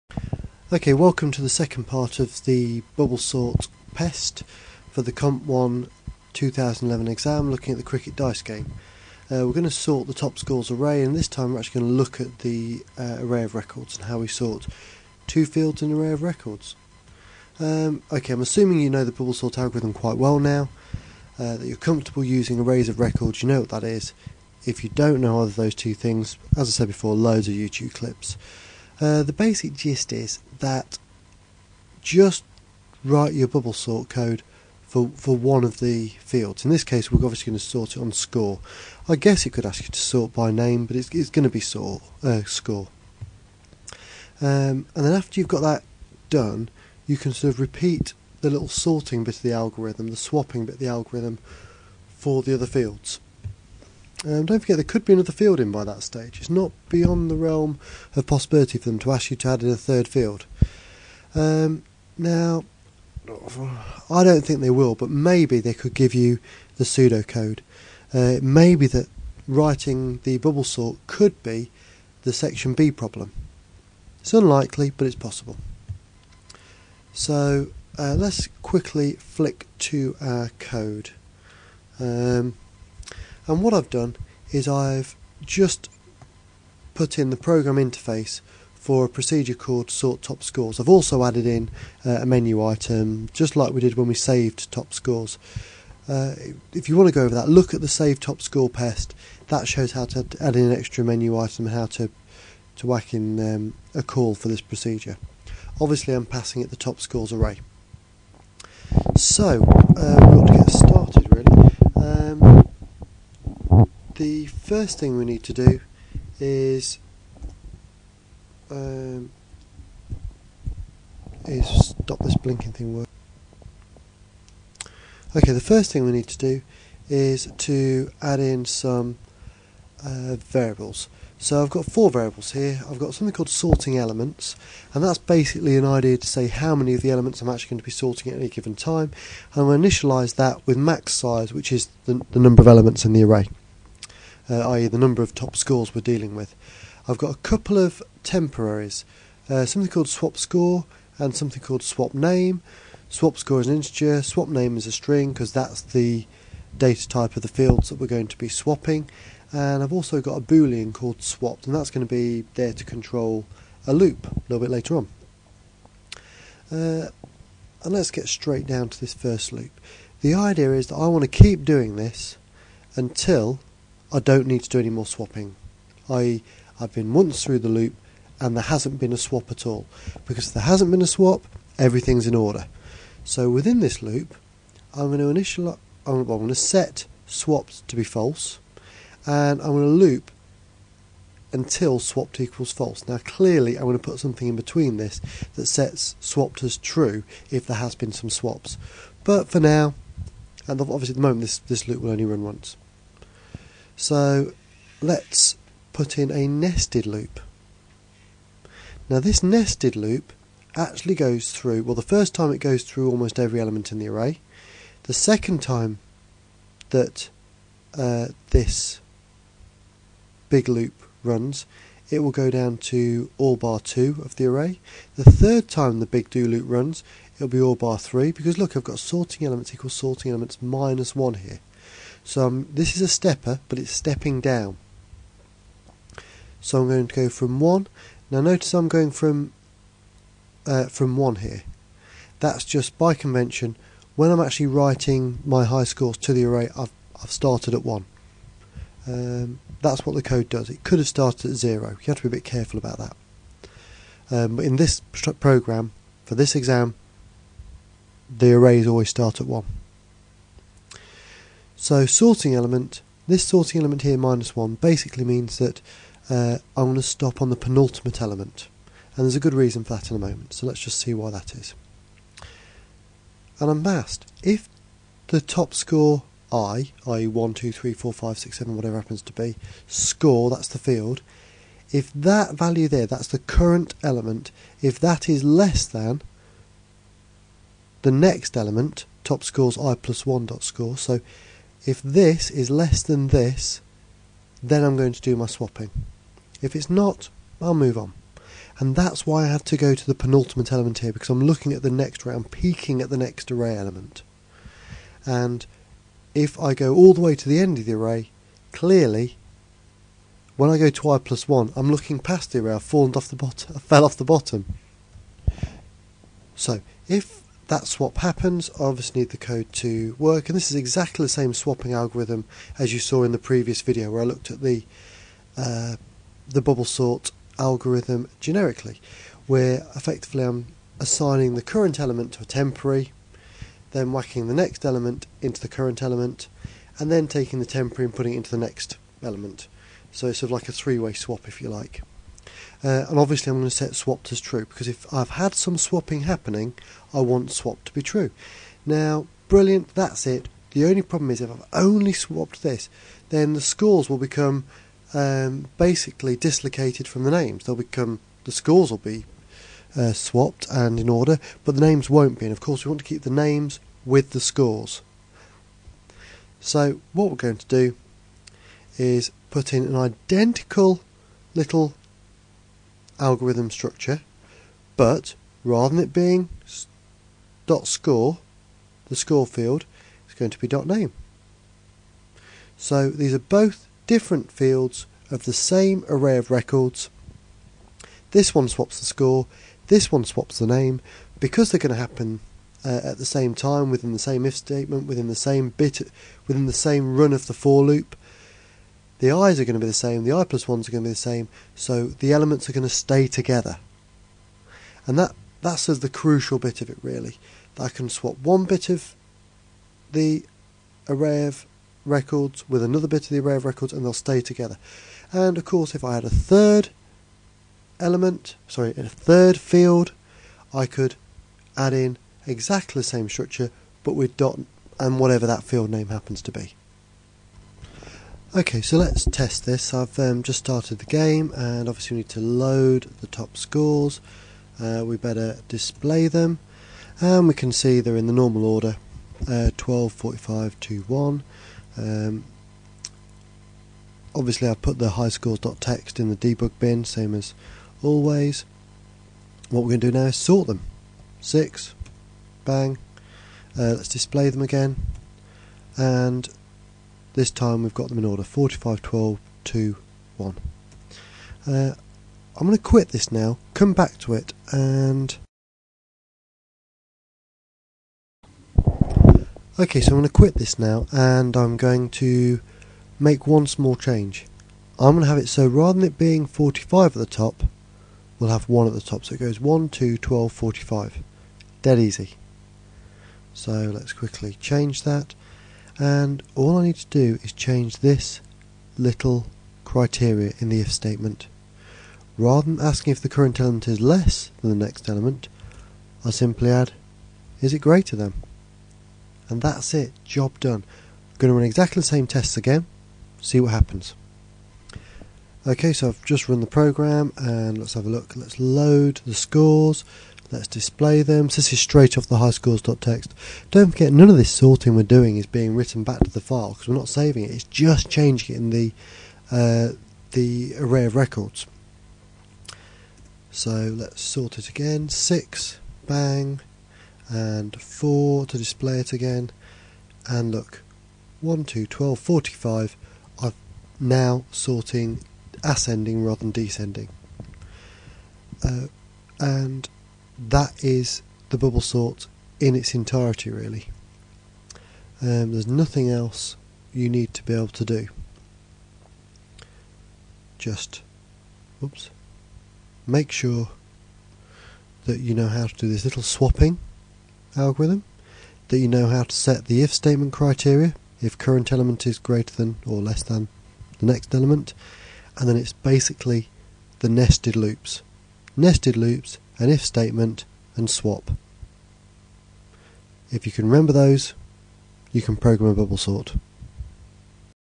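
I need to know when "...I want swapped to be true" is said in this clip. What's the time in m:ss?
5:47.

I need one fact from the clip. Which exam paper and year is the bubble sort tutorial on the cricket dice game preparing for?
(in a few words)
Comp 1 2011.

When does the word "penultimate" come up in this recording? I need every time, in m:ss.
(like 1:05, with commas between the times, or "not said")
4:27, 5:00.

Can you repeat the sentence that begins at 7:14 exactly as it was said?
Uh, we better display them and we can see they're in the normal order uh, 12, 45, 2, 1.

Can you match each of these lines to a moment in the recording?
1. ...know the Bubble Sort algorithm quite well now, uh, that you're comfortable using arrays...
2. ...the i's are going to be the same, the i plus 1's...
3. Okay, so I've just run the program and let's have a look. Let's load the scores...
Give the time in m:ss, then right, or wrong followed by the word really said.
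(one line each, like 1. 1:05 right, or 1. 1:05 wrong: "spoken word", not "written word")
1. 0:18 right
2. 6:39 right
3. 8:25 right.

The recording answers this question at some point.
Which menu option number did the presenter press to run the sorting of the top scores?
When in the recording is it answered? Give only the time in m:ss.
7:31.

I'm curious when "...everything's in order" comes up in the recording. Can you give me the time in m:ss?
3:01.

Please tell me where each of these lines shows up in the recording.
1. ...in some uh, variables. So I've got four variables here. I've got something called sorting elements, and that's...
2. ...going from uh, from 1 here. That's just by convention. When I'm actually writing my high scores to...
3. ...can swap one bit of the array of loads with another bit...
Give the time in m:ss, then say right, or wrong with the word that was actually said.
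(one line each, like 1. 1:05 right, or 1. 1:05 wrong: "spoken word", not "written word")
1. 2:08 right
2. 3:58 right
3. 6:47 wrong: "records", not "loads".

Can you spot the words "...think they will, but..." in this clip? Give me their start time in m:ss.
1:04.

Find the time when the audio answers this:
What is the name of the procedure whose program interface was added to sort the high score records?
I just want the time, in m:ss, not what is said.
1:29.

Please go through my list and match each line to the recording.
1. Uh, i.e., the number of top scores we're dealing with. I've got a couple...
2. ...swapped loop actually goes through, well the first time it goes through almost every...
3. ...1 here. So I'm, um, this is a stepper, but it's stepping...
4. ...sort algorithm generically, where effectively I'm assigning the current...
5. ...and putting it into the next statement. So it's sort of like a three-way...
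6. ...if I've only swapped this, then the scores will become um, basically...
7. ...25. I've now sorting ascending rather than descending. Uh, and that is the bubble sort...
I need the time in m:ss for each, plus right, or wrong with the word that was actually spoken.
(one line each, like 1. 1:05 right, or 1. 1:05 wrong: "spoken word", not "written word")
1. 2:24 right
2. 3:29 wrong: "nested", not "swapped"
3. 3:51 right
4. 5:26 right
5. 5:38 wrong: "element", not "statement"
6. 5:51 right
7. 8:52 wrong: "45", not "25".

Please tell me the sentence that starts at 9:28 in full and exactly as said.
Nested loops an if statement, and swap.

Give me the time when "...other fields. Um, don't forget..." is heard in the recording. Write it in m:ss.
0:52.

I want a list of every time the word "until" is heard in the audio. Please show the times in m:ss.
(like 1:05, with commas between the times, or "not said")
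2:52, 3:11.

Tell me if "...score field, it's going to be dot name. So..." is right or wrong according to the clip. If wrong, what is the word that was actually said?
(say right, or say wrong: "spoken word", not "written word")
right.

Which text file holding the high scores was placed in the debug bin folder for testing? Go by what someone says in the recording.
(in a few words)
highscores.txt.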